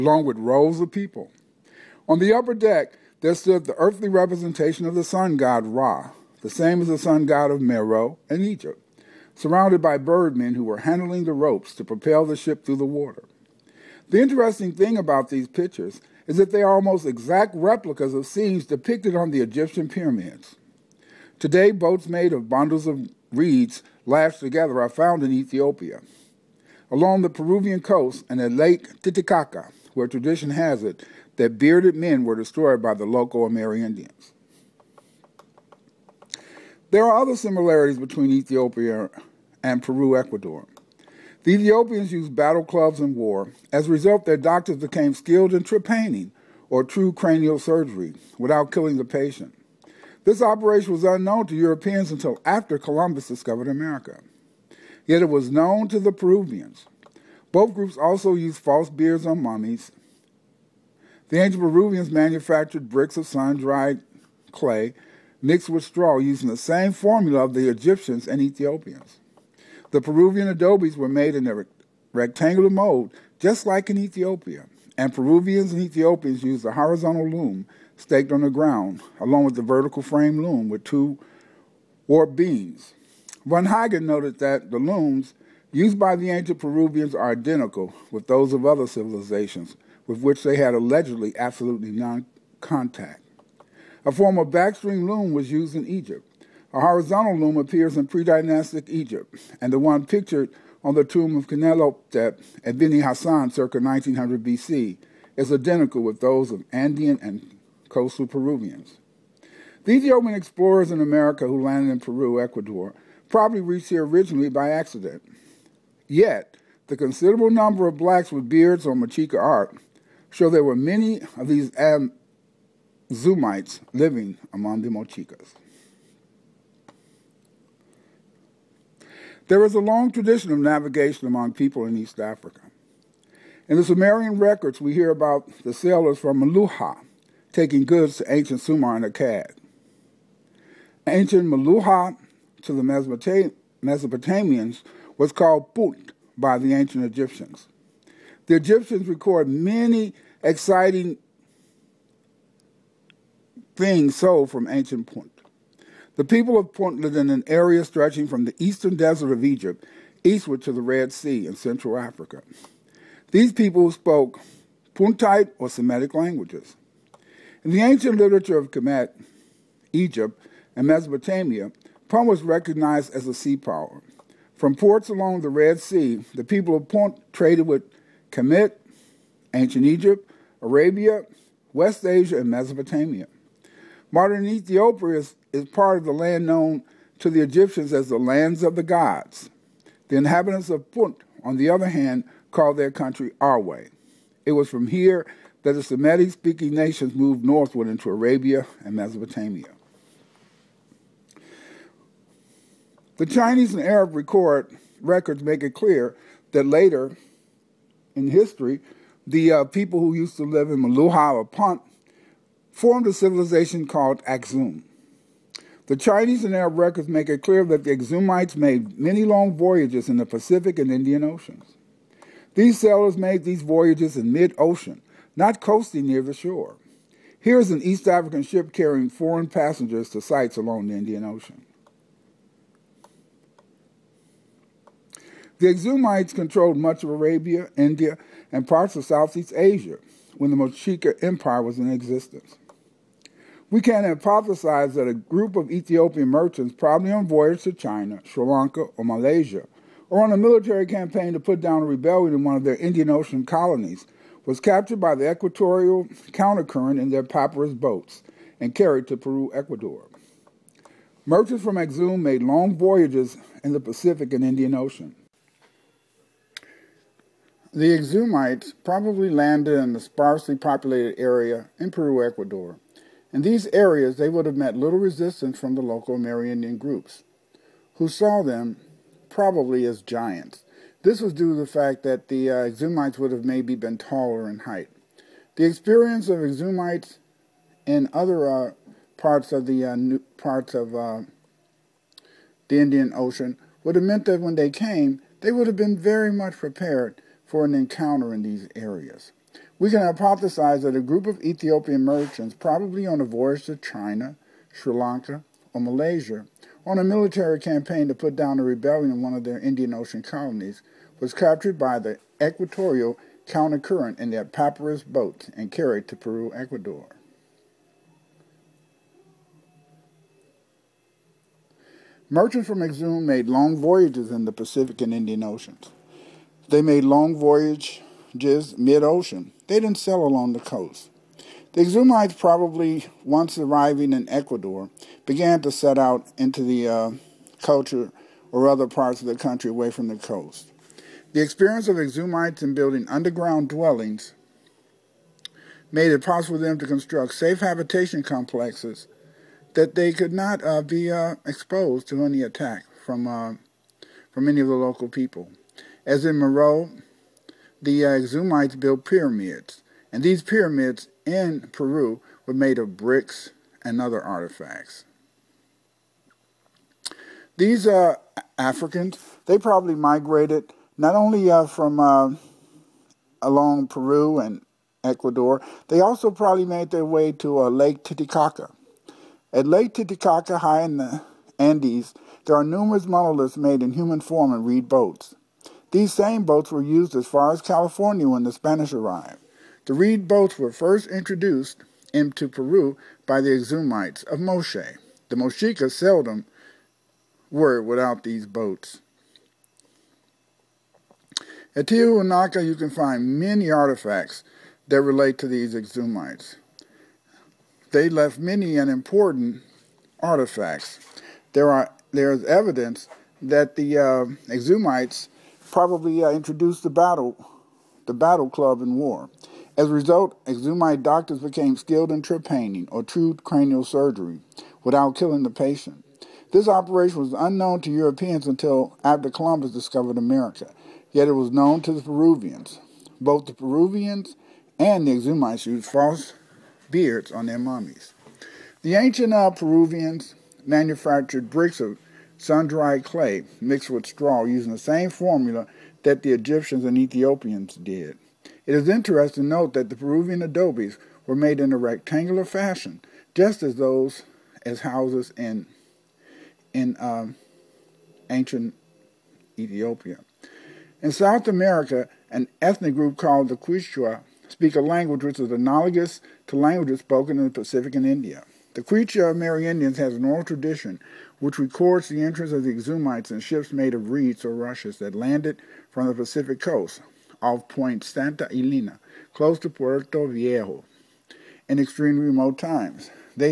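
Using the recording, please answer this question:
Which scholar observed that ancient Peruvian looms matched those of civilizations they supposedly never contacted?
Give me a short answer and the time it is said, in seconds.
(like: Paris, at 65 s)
Von Hagen, at 83 s.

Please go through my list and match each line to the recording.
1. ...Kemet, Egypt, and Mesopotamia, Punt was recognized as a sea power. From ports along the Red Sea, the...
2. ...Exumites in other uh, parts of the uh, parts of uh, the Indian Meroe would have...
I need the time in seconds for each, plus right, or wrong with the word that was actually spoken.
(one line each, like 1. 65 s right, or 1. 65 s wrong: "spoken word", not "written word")
1. 168 s right
2. 286 s wrong: "Ocean", not "Meroe".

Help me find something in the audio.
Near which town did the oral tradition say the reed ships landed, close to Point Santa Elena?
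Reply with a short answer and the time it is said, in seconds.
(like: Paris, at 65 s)
Puerto Viejo, at 479 s.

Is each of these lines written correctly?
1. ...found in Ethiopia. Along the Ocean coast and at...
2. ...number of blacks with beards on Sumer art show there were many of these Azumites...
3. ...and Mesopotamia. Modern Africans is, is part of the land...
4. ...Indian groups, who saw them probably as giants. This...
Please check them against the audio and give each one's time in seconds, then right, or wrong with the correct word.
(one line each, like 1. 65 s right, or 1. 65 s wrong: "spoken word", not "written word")
1. 24 s wrong: "Peruvian", not "Ocean"
2. 117 s wrong: "Mochica", not "Sumer"
3. 182 s wrong: "Ethiopia", not "Africans"
4. 276 s right.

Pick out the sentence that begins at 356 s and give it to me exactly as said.
As in Moreau, the uh, built pyramids, and these pyramids in Peru were made of bricks and other artifacts.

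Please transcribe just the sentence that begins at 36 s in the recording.
There are other similarities between Ethiopia and Peru, Ecuador.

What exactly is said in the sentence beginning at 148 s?
The Egyptians record many exciting things sold from ancient Punt.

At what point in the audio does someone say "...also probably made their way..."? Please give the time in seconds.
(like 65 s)
376 s.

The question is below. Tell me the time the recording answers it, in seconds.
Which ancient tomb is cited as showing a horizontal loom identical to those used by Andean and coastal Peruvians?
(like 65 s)
101 s.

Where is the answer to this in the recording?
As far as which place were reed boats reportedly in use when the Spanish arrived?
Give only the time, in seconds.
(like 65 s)
387 s.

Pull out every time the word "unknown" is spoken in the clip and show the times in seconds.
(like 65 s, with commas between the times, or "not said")
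51 s, 427 s.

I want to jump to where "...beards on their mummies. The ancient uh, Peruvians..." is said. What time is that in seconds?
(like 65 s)
436 s.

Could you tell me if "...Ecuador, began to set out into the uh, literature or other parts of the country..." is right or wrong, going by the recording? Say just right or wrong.
wrong.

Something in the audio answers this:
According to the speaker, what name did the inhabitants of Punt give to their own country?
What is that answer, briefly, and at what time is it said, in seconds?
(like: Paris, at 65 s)
Arwe, at 193 s.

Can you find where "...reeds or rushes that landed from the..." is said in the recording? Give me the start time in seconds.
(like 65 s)
474 s.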